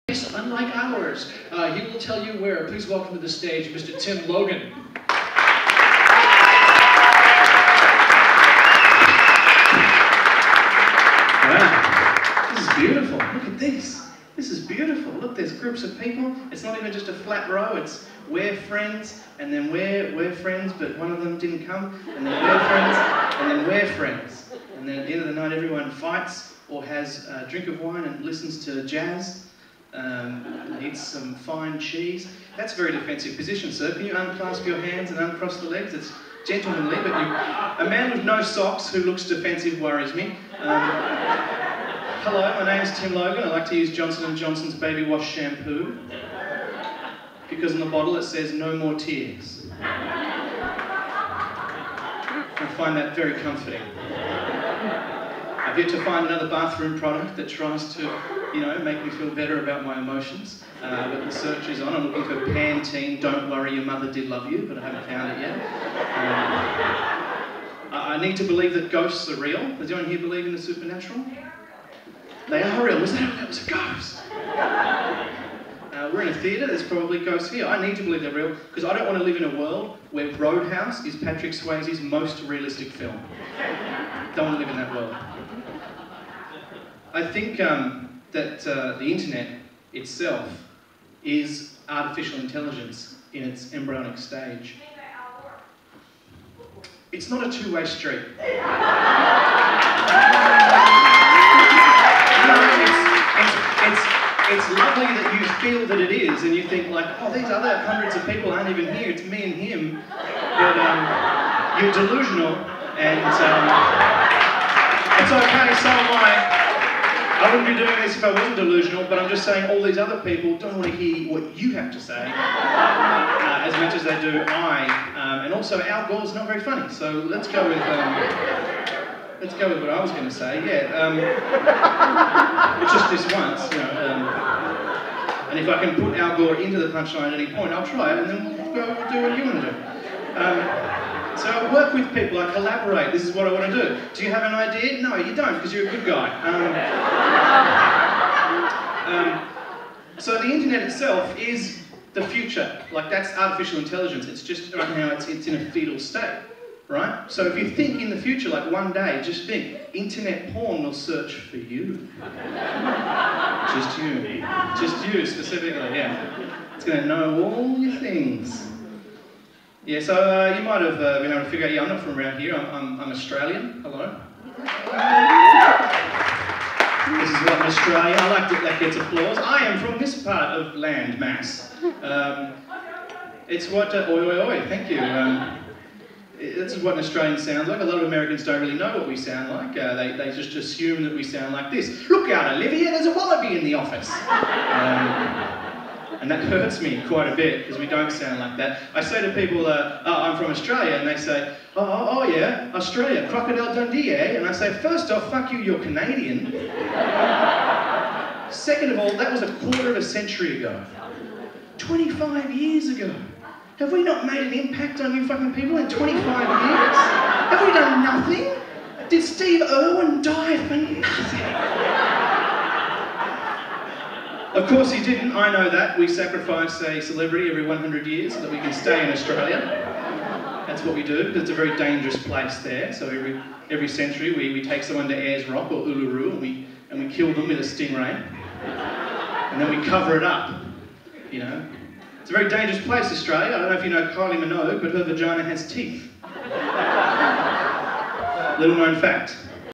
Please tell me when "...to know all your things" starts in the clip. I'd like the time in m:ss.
2:46.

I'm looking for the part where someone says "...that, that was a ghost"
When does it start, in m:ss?
1:13.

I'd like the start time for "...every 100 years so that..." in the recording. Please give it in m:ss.
3:47.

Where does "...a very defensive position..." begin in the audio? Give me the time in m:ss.
0:32.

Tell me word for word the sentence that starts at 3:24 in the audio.
And I say, first off, fuck you, you're Canadian.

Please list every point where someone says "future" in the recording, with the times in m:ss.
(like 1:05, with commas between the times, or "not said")
2:32, 2:38.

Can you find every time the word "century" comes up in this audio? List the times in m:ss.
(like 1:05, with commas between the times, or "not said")
3:30, 3:53.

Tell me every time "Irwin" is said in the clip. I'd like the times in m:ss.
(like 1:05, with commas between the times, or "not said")
3:39.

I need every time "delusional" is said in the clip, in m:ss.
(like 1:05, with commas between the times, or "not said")
1:51, 1:58.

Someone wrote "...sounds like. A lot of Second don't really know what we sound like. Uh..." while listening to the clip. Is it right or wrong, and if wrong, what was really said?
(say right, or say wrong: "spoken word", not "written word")
wrong: "Americans", not "Second".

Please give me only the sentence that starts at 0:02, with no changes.
Please welcome to the stage Mr.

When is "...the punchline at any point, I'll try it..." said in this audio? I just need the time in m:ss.
2:16.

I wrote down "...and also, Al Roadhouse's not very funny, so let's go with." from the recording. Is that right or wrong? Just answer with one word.
wrong.